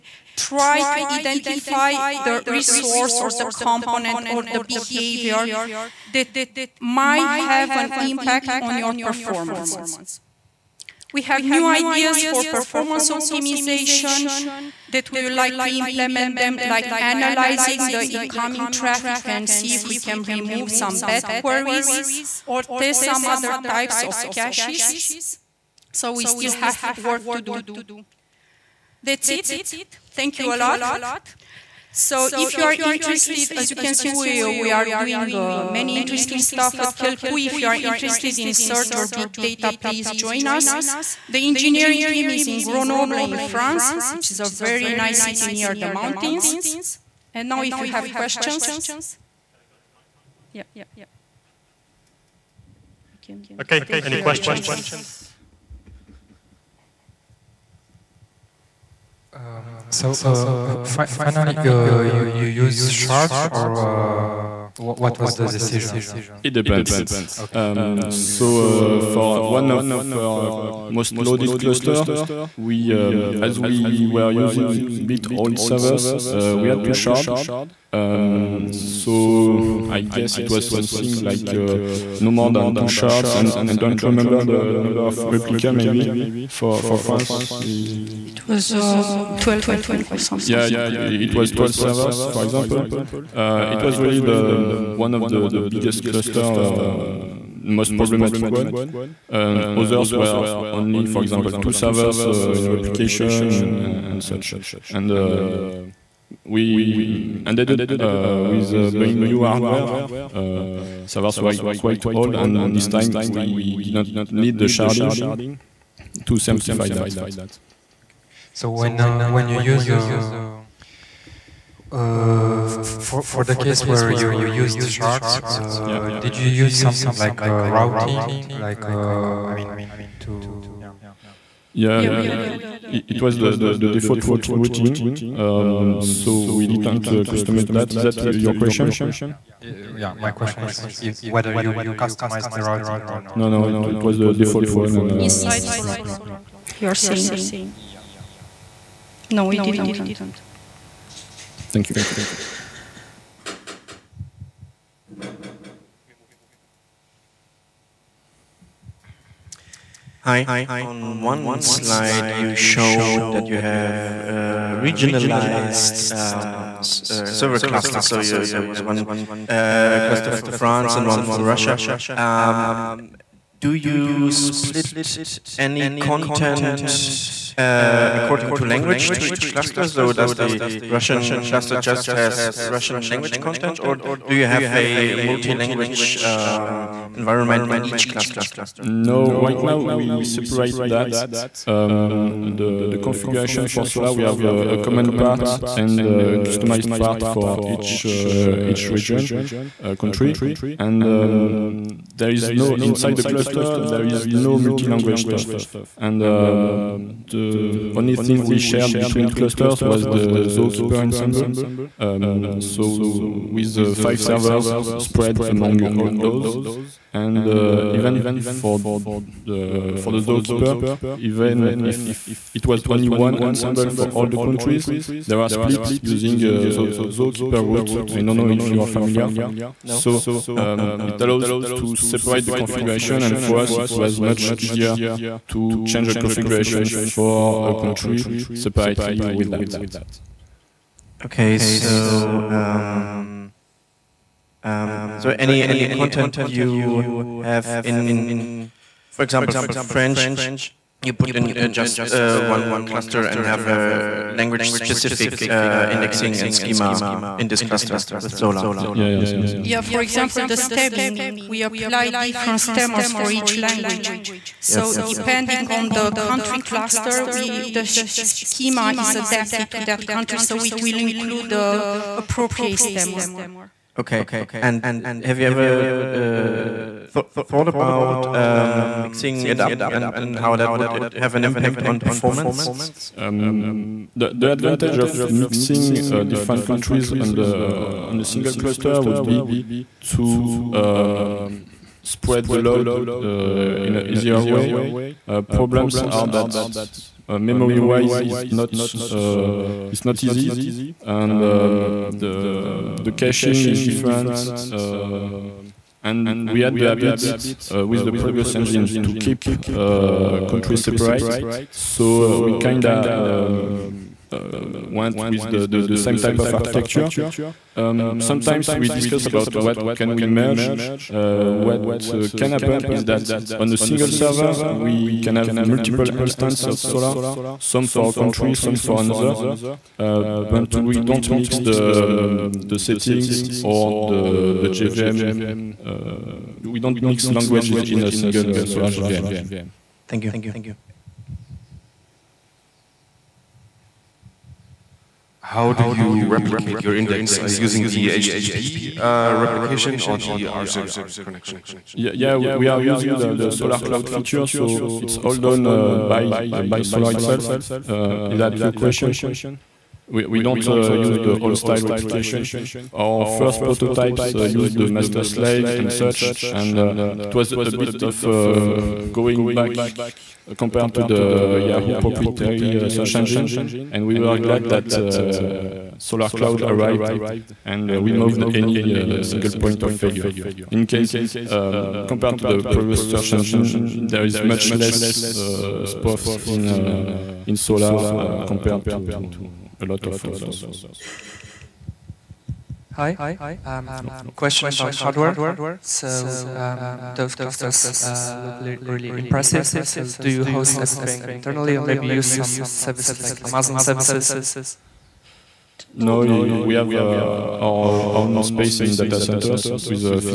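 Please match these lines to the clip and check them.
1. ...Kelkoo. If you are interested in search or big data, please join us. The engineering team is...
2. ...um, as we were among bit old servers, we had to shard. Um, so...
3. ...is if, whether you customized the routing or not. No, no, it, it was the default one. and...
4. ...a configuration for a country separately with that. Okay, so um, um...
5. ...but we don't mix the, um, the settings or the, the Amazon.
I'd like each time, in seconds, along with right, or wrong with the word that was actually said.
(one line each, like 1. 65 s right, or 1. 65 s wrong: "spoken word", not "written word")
1. 36 s right
2. 72 s wrong: "using", not "among"
3. 140 s right
4. 236 s right
5. 330 s wrong: "JVM", not "Amazon".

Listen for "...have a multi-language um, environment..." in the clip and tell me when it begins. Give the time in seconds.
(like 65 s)
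184 s.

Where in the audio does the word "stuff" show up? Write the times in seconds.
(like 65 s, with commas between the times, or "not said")
36 s, 205 s.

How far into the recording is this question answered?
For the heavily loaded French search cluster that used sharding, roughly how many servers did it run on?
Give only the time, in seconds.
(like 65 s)
91 s.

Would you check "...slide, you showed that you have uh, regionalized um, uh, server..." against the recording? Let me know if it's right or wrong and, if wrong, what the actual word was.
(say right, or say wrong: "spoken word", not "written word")
right.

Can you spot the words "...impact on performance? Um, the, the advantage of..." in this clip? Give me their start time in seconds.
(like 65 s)
281 s.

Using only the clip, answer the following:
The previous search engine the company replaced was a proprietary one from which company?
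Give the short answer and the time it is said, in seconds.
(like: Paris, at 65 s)
Yahoo, at 371 s.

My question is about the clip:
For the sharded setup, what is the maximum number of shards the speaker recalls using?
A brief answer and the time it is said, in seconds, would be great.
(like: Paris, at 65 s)
2, at 82 s.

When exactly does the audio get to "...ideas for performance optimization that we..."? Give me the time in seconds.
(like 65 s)
11 s.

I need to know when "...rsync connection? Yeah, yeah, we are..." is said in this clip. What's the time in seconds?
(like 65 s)
350 s.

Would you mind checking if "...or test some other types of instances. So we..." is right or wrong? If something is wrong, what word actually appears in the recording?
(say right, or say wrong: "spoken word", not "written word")
wrong: "caches", not "instances".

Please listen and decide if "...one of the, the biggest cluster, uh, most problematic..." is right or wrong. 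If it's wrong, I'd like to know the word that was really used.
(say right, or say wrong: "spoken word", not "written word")
right.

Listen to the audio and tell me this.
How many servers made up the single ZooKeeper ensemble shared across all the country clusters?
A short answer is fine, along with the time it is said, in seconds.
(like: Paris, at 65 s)
5, at 213 s.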